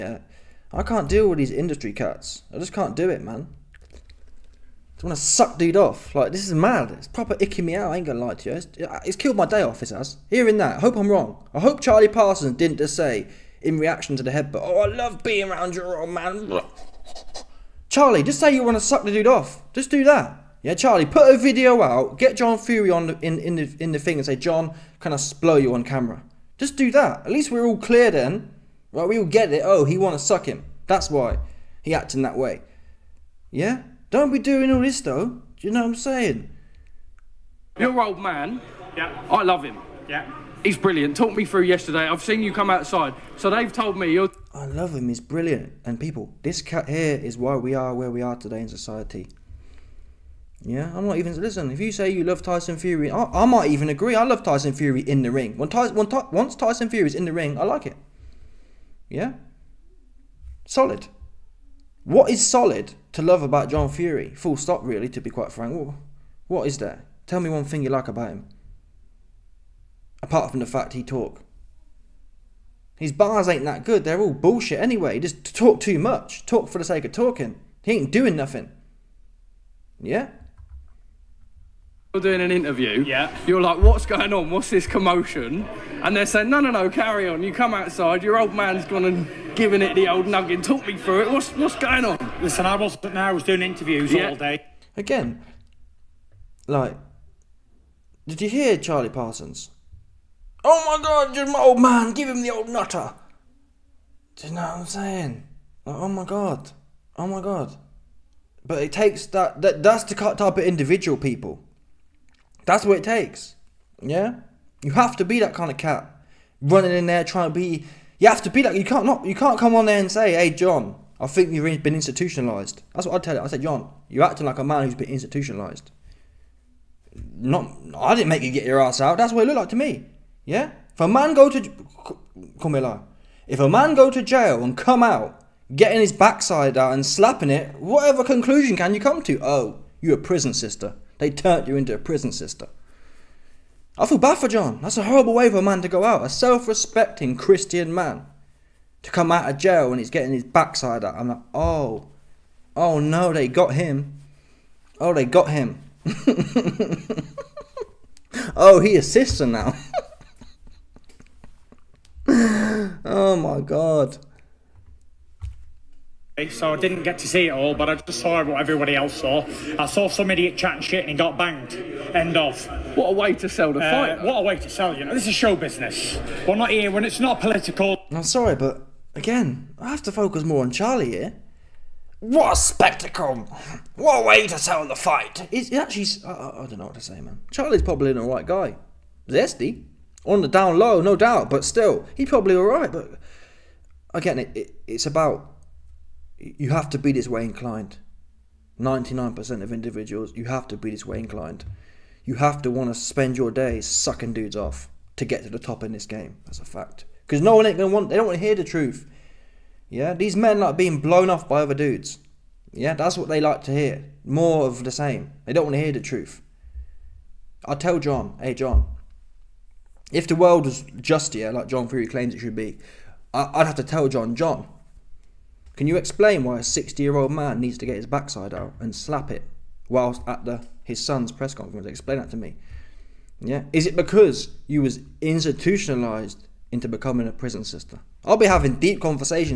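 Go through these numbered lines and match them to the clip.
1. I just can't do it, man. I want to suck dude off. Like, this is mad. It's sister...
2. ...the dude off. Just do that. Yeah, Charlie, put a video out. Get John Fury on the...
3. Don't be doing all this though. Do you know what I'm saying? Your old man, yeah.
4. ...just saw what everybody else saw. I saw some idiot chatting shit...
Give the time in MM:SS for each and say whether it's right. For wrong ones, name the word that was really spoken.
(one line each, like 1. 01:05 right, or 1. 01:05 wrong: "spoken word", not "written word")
1. 00:02 wrong: "proper", not "sister"
2. 00:19 right
3. 00:34 right
4. 02:47 right.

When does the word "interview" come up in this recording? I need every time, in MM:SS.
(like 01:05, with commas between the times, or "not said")
01:22, 01:33.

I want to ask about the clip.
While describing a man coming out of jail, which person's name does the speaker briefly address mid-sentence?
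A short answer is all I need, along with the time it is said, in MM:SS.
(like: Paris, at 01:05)
Camilla, at 02:12.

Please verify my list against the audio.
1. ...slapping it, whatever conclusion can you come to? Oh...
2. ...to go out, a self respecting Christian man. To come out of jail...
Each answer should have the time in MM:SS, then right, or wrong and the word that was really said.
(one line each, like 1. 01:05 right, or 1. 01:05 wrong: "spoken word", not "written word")
1. 02:17 right
2. 02:25 right.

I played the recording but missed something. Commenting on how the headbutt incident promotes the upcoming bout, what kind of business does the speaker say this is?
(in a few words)
Show business.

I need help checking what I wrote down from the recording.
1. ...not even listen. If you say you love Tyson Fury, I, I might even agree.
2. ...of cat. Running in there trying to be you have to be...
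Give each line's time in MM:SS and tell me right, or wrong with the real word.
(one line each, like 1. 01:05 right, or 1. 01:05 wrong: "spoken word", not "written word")
1. 00:51 right
2. 01:55 right.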